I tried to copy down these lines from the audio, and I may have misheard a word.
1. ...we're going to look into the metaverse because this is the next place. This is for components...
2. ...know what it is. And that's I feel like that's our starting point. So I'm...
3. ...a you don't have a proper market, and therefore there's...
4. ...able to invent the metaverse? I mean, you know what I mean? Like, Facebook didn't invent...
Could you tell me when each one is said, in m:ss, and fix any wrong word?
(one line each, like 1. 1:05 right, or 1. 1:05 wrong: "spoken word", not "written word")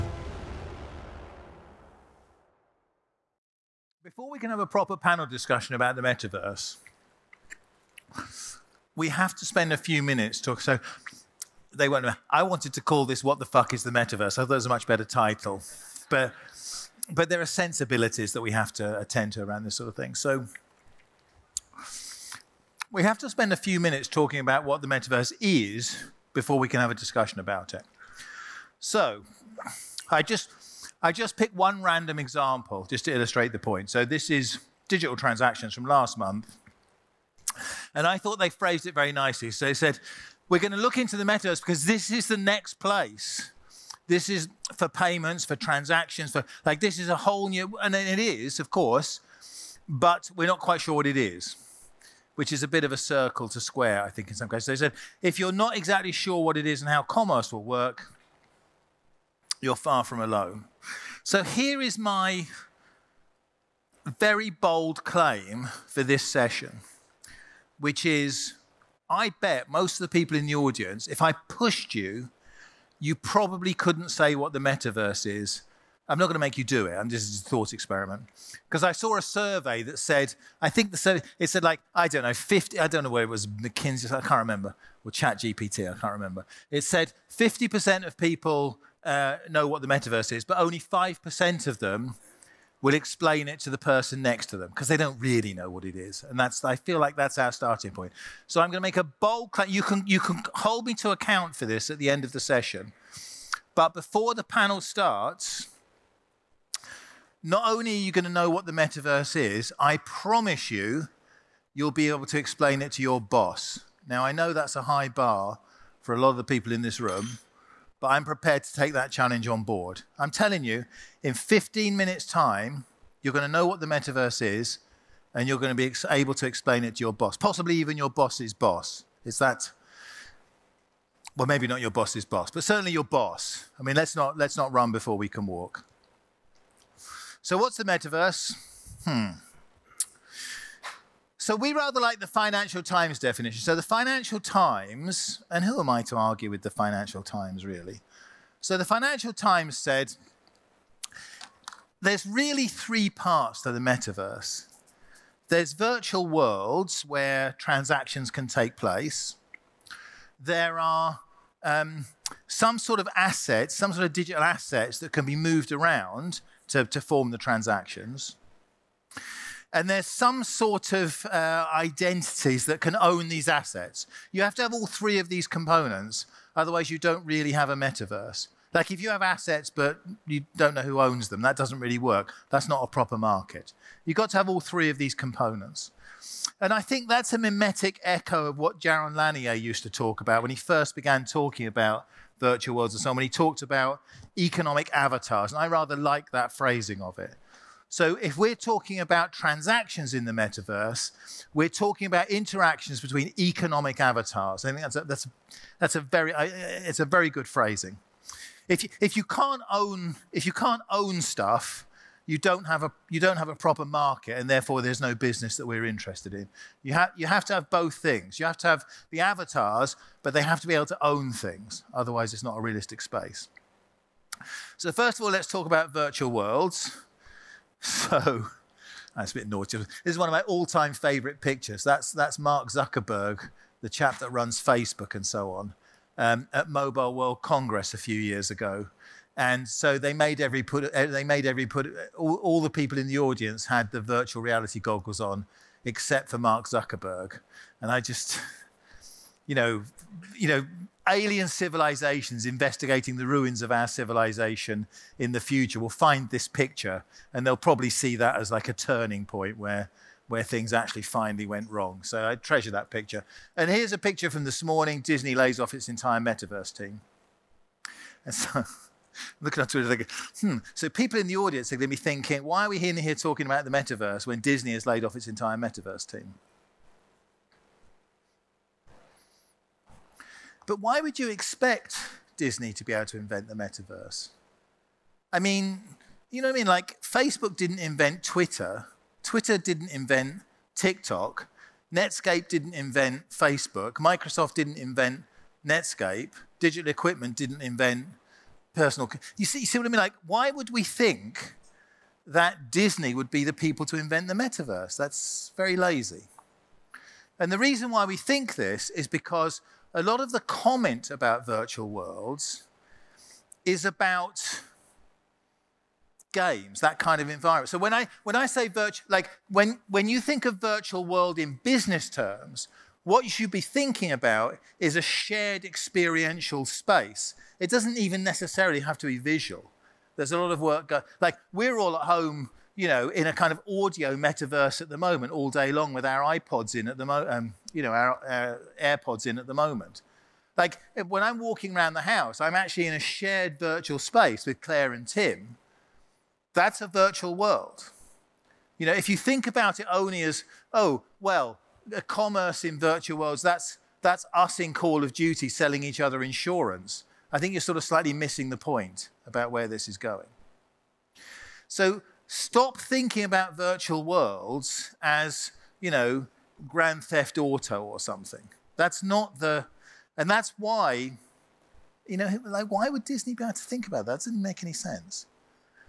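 1. 0:40 wrong: "payments", not "components"
2. 1:35 right
3. 3:32 right
4. 4:42 right.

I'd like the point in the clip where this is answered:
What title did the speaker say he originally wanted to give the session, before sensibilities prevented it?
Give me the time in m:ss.
0:13.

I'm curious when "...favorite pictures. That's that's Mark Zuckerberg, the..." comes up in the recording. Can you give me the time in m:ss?
3:50.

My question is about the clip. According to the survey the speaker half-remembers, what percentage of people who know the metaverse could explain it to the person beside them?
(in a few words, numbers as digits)
5%.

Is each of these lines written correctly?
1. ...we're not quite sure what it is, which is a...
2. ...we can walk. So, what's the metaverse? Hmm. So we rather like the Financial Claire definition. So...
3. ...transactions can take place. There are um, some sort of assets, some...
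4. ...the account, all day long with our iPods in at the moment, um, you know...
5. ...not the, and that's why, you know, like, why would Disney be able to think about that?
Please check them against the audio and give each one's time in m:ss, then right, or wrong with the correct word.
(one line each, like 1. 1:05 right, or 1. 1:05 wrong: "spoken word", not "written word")
1. 0:50 right
2. 2:15 wrong: "Times", not "Claire"
3. 2:37 right
4. 5:34 wrong: "moment", not "account"
5. 6:09 right.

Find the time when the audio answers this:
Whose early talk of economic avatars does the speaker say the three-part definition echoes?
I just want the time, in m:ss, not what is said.
3:08.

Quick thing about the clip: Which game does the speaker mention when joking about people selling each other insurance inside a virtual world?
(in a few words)
Call of Duty.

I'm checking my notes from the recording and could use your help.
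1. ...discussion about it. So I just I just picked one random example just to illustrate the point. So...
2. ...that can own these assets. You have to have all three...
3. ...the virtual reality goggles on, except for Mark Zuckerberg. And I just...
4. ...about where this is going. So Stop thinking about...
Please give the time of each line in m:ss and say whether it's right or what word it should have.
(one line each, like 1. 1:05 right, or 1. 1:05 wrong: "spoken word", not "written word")
1. 0:26 right
2. 2:52 right
3. 4:03 right
4. 5:59 right.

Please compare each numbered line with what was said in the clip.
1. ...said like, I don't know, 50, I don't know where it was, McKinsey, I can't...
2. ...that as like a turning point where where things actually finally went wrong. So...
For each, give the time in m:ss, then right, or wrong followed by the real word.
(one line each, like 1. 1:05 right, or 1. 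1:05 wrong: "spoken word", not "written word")
1. 1:21 right
2. 4:18 right.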